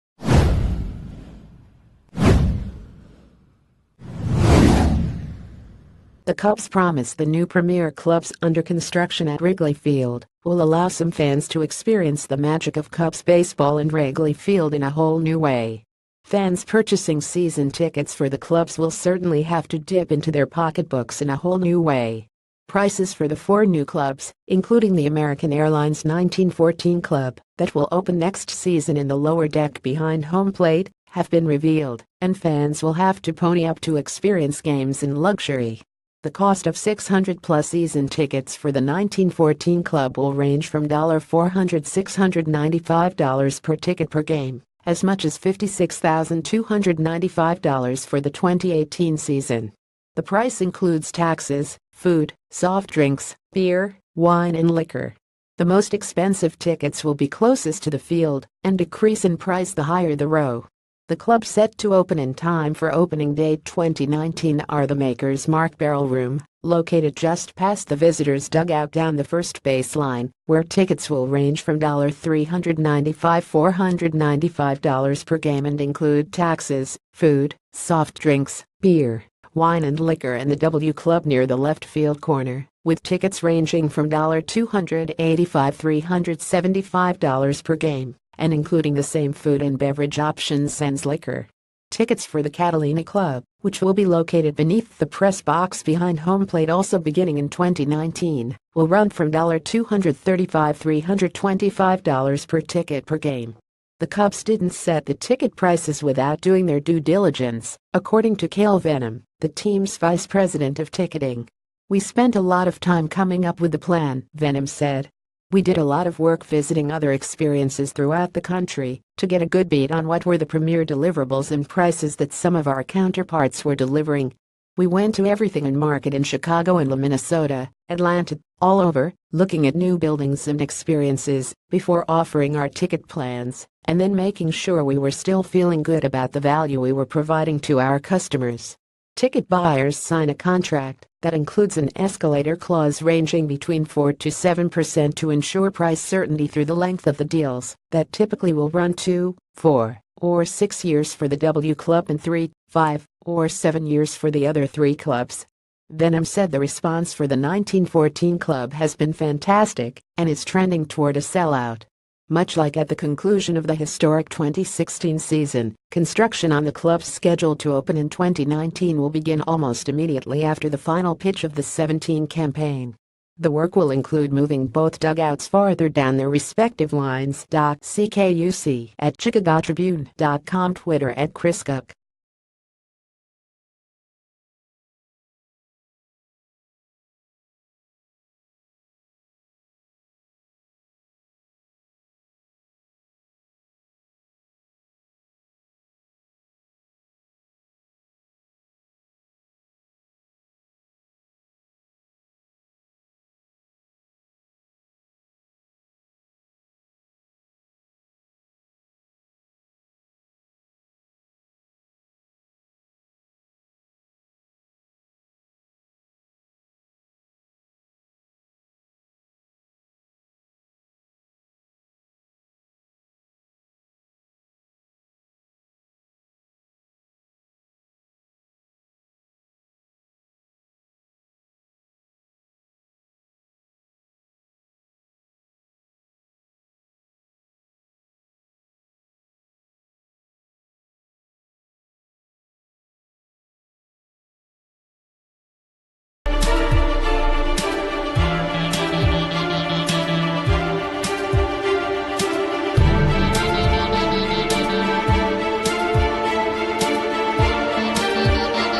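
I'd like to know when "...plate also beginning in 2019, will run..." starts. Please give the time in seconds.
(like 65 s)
96 s.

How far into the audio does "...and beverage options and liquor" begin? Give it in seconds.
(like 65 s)
89 s.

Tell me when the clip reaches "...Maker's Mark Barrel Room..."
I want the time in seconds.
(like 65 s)
64 s.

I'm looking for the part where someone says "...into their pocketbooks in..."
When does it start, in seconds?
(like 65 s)
20 s.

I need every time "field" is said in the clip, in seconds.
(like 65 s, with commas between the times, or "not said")
9 s, 14 s, 57 s, 81 s.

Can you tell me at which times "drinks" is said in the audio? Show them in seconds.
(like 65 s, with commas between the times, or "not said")
52 s, 78 s.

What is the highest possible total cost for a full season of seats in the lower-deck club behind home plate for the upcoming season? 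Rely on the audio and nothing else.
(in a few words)
$56,295.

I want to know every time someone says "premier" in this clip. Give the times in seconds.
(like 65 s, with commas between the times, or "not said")
7 s, 120 s.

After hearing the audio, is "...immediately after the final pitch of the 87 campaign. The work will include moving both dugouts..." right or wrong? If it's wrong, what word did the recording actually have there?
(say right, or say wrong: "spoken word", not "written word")
wrong: "17", not "87".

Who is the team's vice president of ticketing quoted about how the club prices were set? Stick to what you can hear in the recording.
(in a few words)
Cale Vennum.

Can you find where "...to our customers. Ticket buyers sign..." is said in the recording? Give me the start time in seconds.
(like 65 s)
137 s.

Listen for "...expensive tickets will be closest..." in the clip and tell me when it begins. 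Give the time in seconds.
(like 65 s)
55 s.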